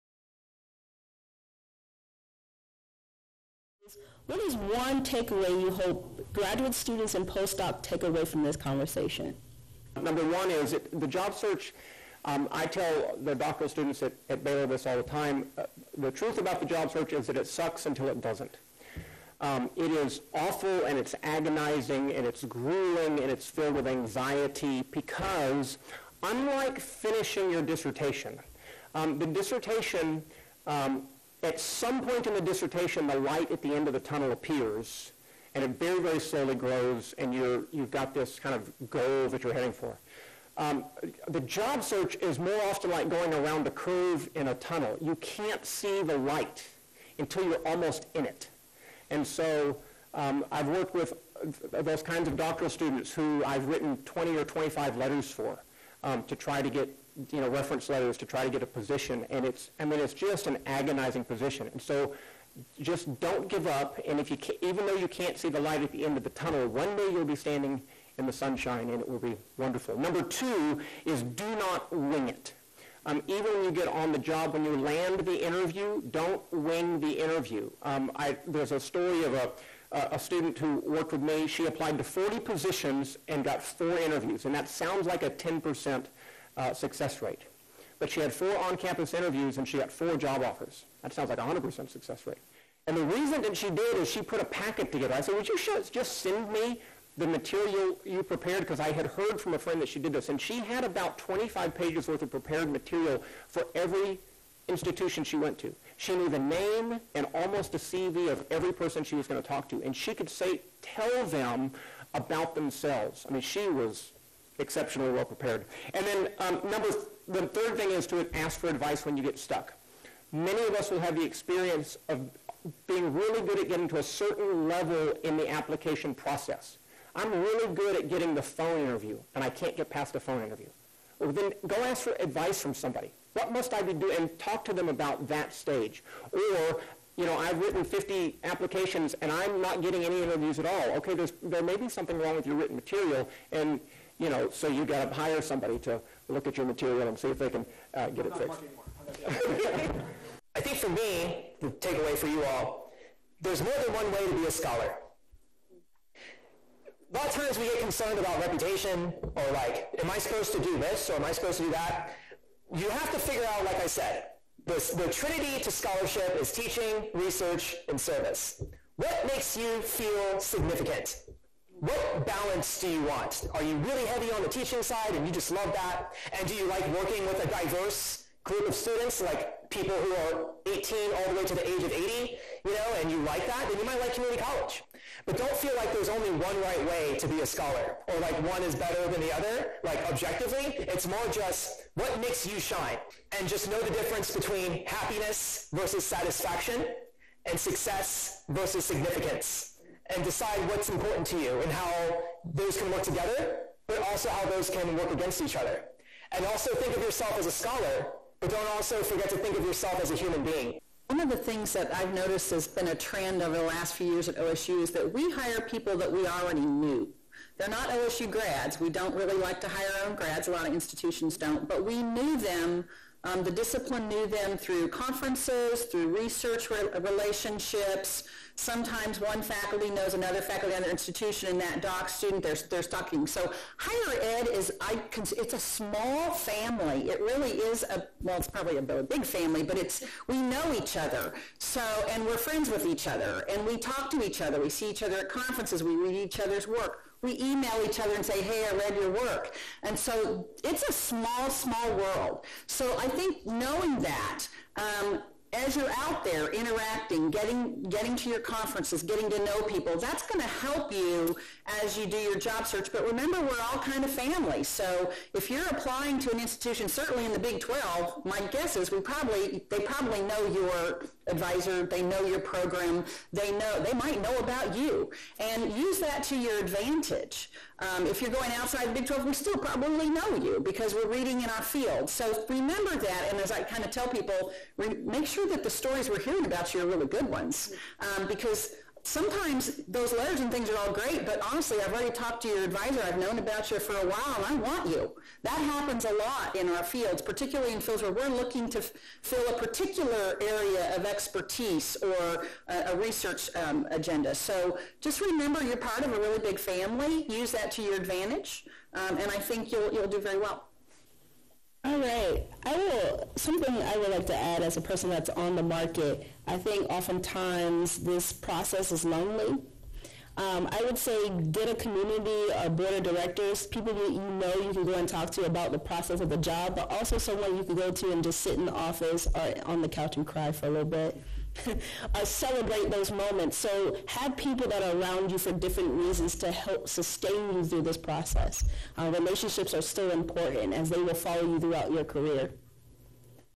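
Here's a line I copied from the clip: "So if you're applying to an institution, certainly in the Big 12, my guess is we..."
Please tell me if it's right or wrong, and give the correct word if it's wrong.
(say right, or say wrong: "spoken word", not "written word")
right.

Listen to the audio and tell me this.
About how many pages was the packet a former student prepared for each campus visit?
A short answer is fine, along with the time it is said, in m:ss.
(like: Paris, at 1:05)
25, at 1:41.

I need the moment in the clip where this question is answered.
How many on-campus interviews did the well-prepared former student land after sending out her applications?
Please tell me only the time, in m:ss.
1:23.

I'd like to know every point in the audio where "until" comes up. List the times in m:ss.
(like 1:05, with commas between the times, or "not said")
0:17, 0:47.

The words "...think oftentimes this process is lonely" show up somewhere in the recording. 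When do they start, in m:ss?
5:16.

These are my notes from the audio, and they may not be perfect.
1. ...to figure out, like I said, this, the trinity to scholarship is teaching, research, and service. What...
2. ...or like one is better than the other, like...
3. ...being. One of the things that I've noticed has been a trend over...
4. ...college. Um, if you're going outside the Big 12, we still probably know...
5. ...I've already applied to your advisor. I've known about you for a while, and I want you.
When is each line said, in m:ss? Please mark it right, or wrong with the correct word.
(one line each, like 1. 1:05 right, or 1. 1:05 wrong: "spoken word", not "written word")
1. 2:43 right
2. 3:08 right
3. 3:30 right
4. 4:36 wrong: "advantage", not "college"
5. 4:51 wrong: "talked", not "applied".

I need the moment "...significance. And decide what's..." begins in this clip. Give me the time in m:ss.
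3:18.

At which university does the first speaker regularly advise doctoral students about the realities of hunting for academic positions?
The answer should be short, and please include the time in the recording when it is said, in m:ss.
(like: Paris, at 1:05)
Baylor, at 0:14.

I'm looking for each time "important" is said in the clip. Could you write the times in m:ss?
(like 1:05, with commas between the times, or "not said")
3:20, 5:40.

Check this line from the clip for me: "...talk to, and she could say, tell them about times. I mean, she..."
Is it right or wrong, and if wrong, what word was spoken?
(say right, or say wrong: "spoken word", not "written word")
wrong: "themselves", not "times".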